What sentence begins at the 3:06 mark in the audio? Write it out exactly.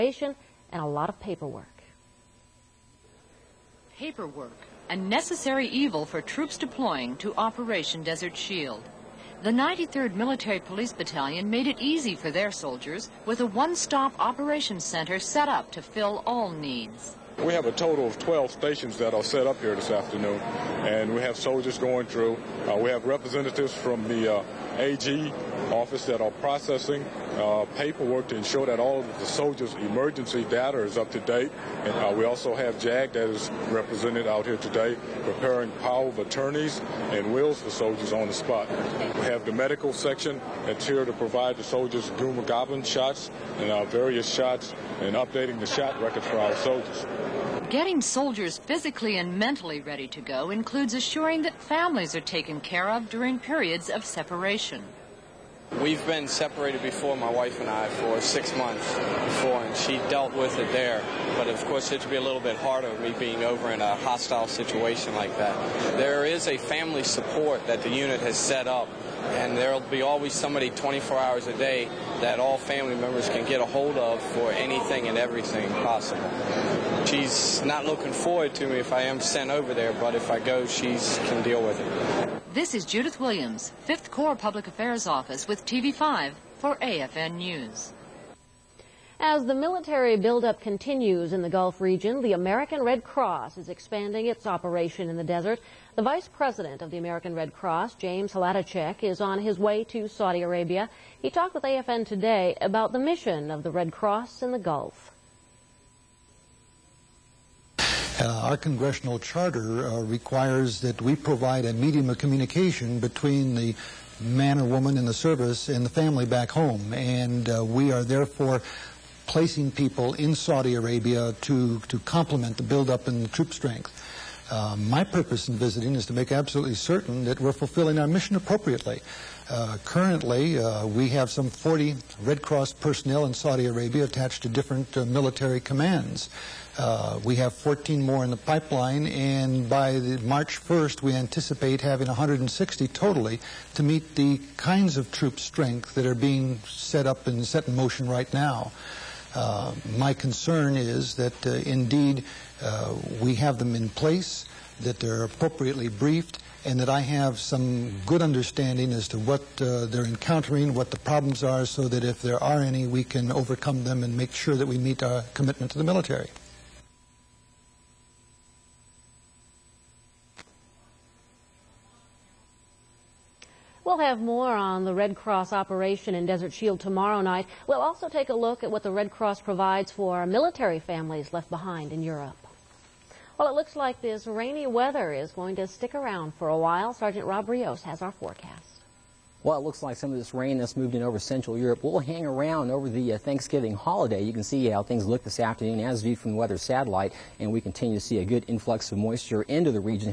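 Sergeant Rob Rios has our forecast.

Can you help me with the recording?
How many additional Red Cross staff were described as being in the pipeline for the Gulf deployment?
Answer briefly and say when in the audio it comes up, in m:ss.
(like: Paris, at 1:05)
14, at 2:17.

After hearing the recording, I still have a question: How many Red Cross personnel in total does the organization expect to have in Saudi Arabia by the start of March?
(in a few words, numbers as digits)
160.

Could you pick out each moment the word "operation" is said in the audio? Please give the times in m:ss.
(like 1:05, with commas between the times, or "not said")
0:07, 0:14, 1:34, 2:55.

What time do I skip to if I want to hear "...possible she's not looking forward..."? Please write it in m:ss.
1:15.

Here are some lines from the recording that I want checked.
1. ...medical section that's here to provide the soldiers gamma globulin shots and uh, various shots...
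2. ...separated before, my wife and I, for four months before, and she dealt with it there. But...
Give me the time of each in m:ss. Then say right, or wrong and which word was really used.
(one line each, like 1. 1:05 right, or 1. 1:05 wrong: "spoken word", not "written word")
1. 0:39 right
2. 0:56 wrong: "six", not "four".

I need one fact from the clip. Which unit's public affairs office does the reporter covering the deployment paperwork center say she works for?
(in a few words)
5th Corps.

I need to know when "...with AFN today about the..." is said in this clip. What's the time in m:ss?
1:41.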